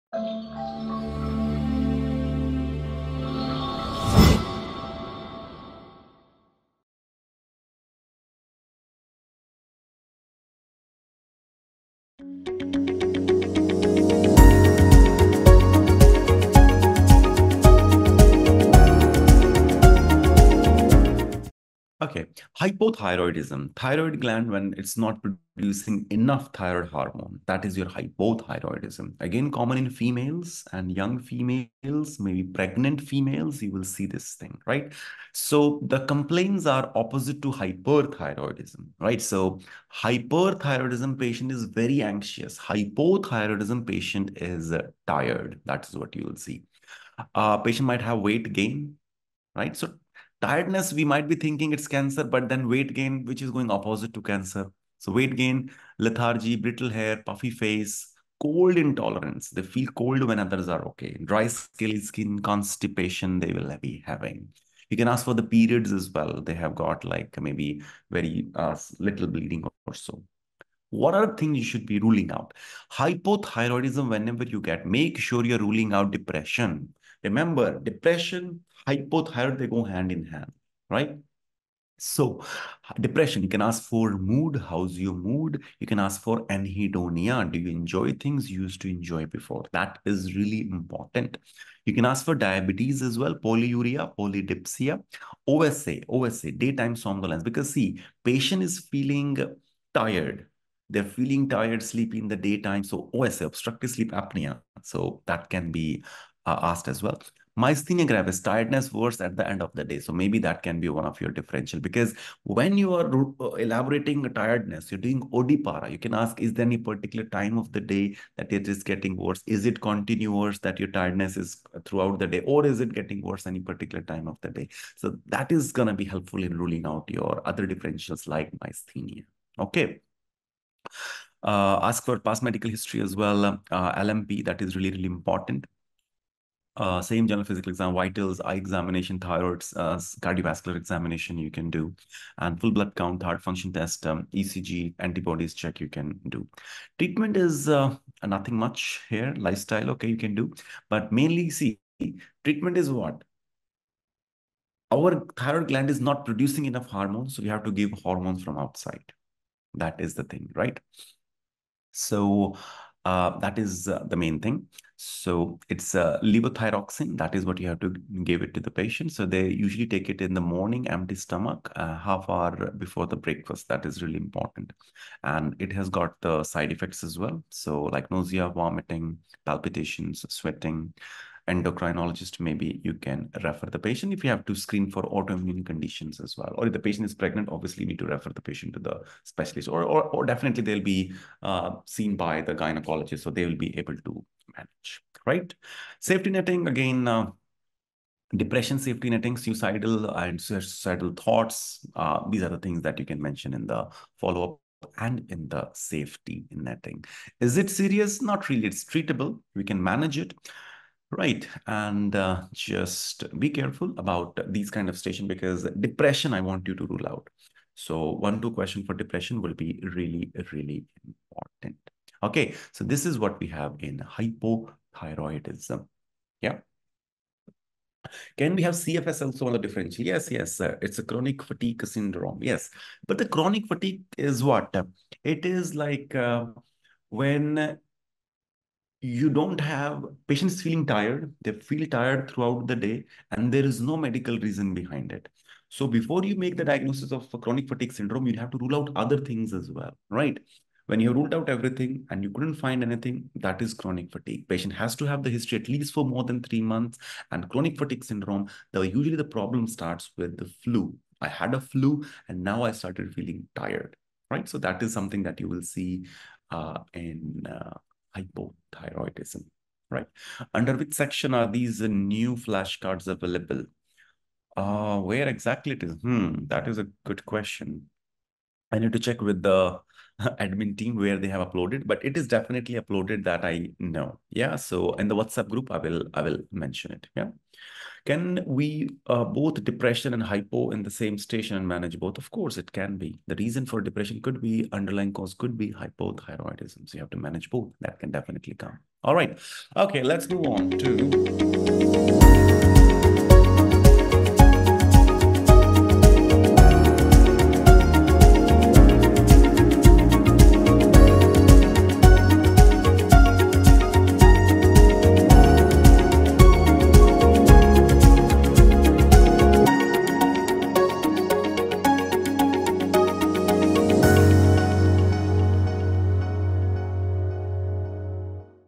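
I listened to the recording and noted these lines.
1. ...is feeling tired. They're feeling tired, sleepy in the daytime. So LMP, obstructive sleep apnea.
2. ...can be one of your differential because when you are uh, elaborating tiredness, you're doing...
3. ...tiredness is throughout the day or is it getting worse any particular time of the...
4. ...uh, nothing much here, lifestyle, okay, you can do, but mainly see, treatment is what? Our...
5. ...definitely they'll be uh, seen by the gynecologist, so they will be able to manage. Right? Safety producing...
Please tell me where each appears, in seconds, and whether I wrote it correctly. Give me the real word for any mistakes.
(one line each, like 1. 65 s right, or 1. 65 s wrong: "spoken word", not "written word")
1. 98 s wrong: "OSA", not "LMP"
2. 110 s right
3. 120 s right
4. 147 s right
5. 190 s wrong: "netting", not "producing".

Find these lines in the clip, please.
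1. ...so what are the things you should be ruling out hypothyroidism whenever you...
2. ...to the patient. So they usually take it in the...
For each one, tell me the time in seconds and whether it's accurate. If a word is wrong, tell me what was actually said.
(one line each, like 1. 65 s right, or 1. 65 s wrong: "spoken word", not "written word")
1. 69 s right
2. 168 s right.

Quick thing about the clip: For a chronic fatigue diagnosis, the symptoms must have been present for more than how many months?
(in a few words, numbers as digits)
3 months.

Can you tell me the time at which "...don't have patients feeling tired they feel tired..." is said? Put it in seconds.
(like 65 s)
239 s.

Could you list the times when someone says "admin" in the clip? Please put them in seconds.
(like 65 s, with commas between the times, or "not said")
280 s.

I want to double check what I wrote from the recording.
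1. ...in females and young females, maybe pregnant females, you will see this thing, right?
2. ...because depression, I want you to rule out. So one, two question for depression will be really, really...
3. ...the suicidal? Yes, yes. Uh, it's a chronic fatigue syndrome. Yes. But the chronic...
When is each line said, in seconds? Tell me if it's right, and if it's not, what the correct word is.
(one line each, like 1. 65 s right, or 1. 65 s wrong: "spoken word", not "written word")
1. 29 s right
2. 215 s right
3. 229 s wrong: "differential", not "suicidal".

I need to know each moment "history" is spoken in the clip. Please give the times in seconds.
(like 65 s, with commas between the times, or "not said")
132 s, 255 s.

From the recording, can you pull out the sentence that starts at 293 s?
The reason for depression could be underlying cause could be hypothyroidism.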